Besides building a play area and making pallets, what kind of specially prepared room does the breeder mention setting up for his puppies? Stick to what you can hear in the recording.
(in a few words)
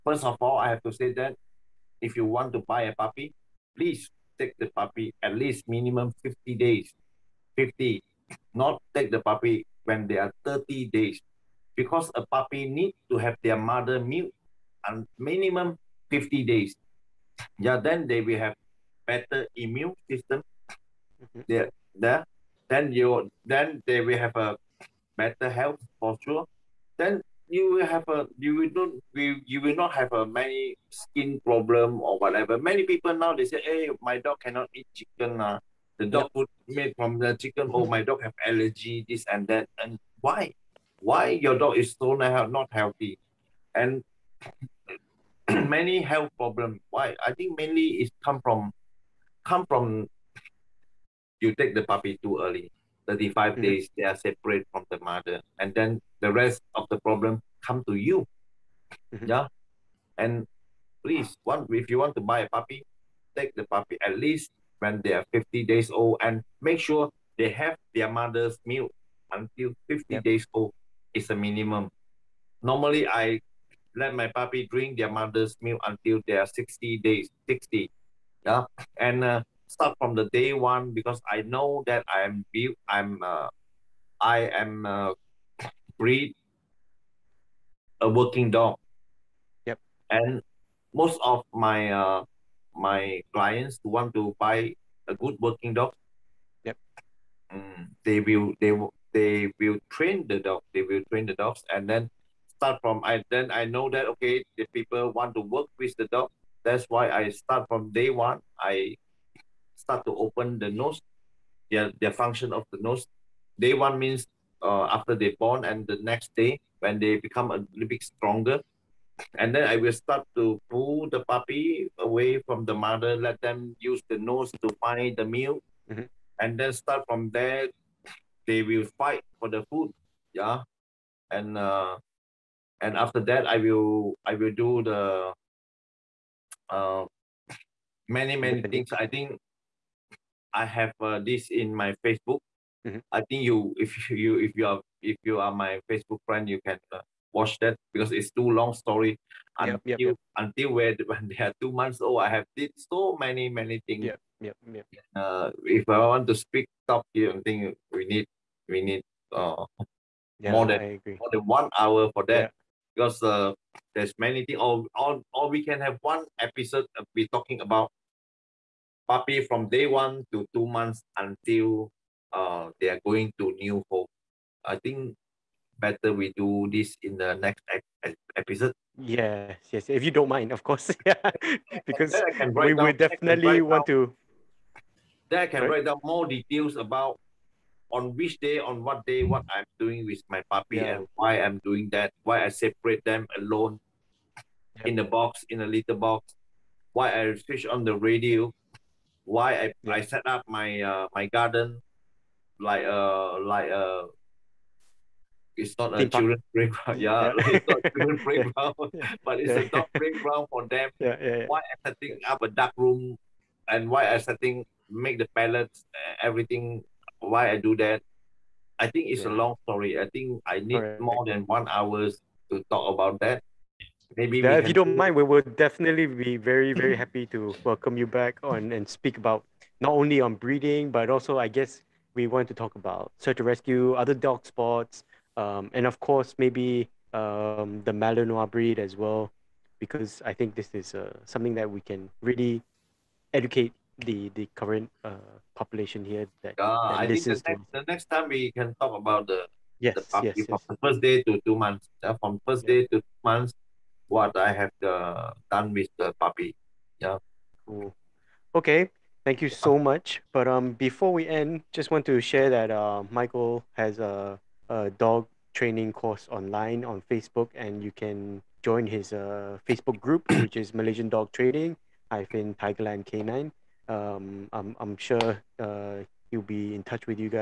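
dark room.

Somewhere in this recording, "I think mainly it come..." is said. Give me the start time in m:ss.
0:47.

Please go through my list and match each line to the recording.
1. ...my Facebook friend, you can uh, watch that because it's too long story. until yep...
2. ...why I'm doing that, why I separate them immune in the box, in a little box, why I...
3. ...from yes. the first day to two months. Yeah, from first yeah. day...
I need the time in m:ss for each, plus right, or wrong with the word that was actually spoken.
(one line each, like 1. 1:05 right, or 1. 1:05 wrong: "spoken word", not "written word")
1. 2:25 right
2. 3:11 wrong: "alone", not "immune"
3. 4:10 right.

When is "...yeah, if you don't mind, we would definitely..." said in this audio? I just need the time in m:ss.
3:44.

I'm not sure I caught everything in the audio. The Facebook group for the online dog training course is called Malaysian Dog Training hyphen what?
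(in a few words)
Tigerland Canine.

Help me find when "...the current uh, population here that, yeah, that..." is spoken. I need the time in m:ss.
4:04.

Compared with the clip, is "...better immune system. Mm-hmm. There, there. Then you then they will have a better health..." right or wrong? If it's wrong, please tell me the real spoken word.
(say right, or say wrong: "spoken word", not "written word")
right.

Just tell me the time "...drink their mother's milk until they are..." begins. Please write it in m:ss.
1:14.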